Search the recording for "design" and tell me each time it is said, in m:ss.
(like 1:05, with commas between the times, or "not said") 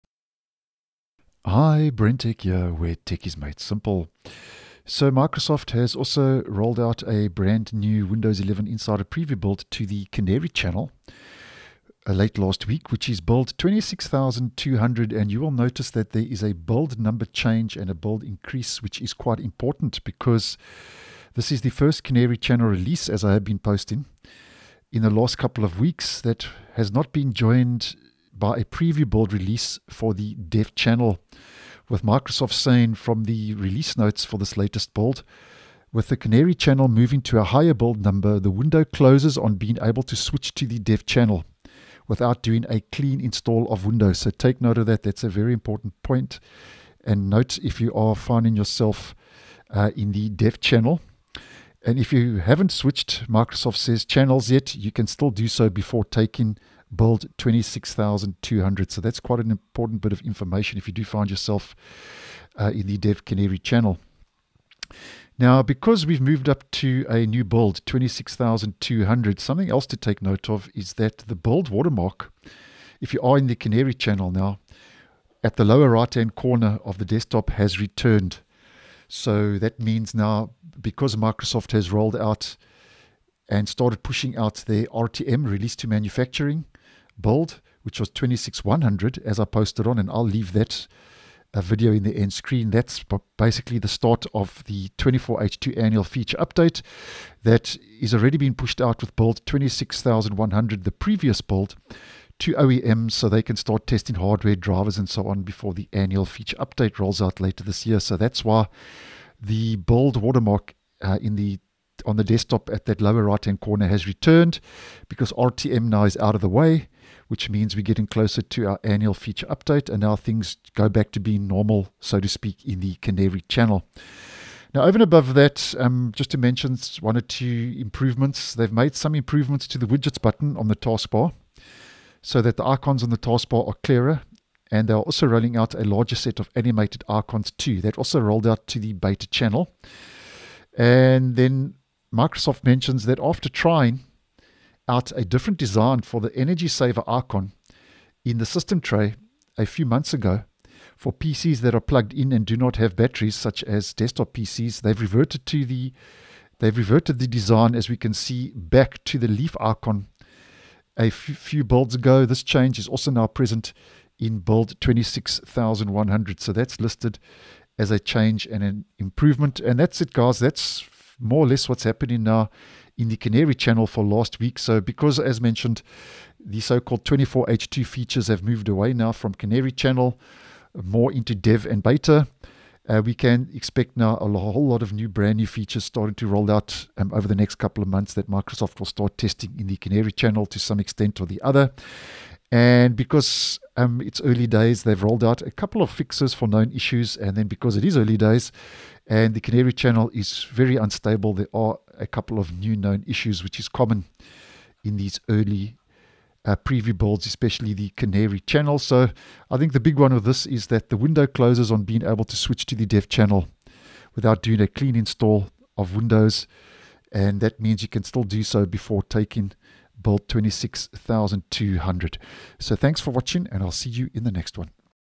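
2:25, 2:37.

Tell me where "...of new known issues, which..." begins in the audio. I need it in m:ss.
3:22.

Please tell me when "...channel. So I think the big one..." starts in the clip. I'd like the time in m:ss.
3:28.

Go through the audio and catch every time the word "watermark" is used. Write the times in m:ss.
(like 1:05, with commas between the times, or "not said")
1:11, 1:50.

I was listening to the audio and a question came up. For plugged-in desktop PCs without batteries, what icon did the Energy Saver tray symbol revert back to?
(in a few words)
leaf icon.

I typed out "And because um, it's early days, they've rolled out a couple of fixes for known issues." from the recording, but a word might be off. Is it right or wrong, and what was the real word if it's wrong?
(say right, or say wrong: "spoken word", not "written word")
right.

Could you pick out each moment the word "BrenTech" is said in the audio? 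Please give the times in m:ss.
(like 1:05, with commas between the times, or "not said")
0:01.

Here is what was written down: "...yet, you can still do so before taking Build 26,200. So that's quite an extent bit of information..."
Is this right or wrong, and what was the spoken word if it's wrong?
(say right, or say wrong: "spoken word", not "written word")
wrong: "important", not "extent".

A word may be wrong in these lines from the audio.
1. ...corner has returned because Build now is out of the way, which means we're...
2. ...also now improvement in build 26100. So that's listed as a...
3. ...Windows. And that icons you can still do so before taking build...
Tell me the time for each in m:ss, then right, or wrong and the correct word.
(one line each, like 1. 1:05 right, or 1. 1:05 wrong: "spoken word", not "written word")
1. 1:53 wrong: "RTM", not "Build"
2. 2:42 wrong: "present", not "improvement"
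3. 3:35 wrong: "means", not "icons".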